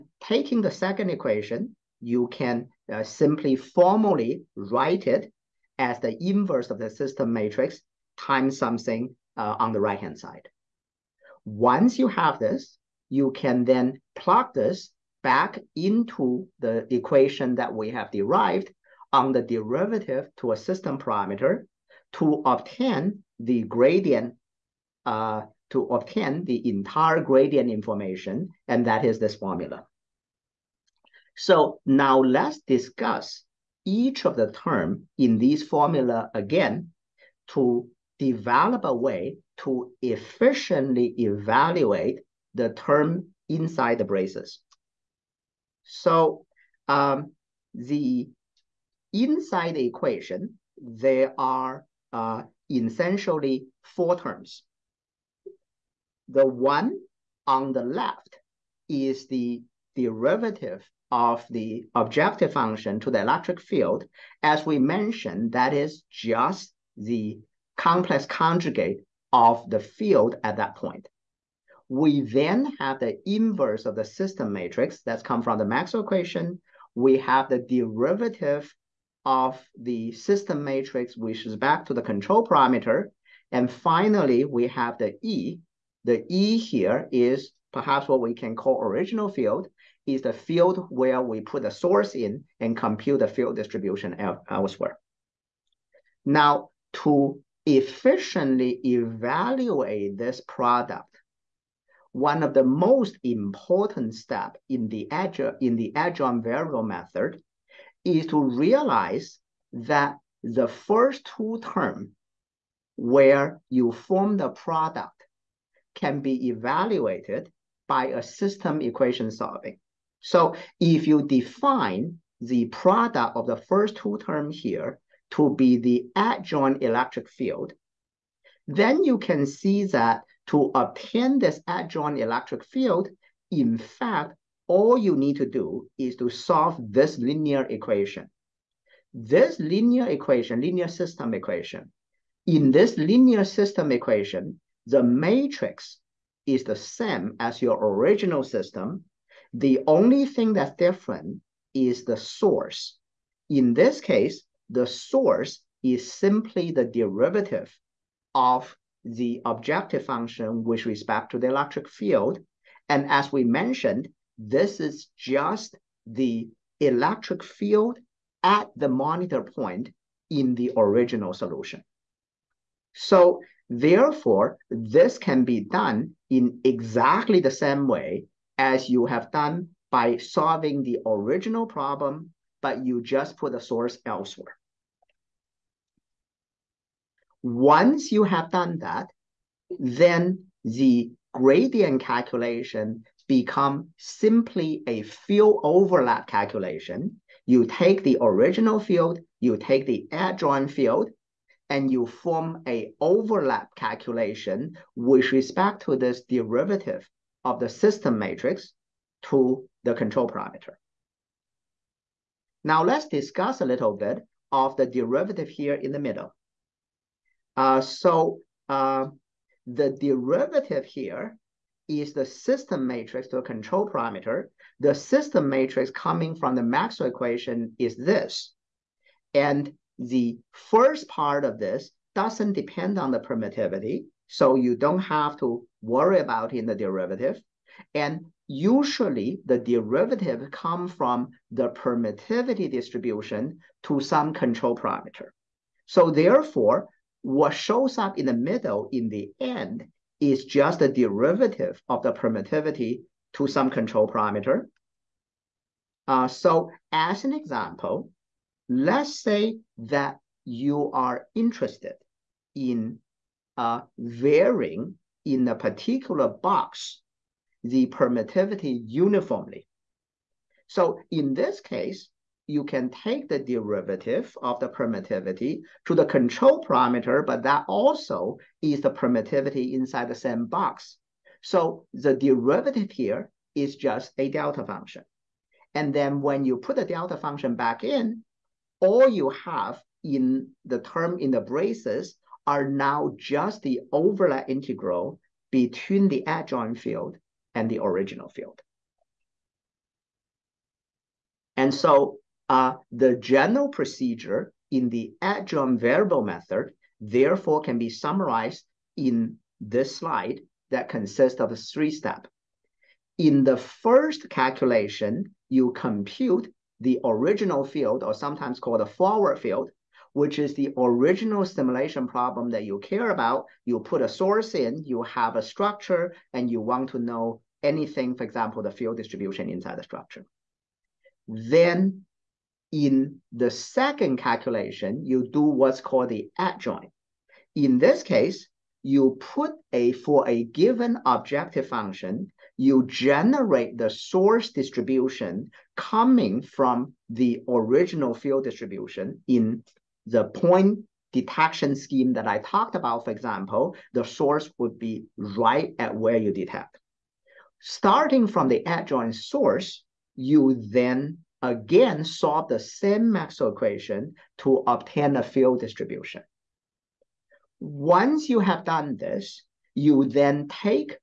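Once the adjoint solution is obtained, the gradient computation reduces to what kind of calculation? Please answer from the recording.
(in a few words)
Field overlap calculation.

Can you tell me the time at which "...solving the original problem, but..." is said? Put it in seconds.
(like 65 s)
180 s.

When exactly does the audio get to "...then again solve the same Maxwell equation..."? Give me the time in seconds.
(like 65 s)
360 s.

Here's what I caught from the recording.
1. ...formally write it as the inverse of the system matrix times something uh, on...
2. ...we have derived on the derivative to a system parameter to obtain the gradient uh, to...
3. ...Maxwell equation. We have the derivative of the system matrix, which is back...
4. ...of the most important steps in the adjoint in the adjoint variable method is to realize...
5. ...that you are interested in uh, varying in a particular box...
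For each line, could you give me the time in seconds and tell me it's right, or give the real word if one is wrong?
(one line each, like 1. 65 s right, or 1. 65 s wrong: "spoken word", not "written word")
1. 3 s right
2. 17 s right
3. 75 s right
4. 102 s right
5. 259 s right.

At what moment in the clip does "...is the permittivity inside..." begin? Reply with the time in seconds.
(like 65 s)
278 s.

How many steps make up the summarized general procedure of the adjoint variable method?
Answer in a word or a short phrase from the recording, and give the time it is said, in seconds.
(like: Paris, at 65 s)
3, at 311 s.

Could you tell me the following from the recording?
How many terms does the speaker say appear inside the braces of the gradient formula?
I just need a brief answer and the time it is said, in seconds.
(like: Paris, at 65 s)
4, at 53 s.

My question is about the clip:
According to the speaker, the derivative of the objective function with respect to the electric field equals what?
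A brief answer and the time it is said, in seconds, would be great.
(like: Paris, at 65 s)
Complex conjugate of the field, at 67 s.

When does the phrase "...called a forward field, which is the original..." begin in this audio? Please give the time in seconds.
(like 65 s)
318 s.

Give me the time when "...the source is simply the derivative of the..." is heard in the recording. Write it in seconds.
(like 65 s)
154 s.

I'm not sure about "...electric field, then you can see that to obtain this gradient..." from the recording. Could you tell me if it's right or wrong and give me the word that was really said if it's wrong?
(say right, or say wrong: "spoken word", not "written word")
wrong: "adjoint", not "gradient".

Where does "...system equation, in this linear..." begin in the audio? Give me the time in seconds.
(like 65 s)
140 s.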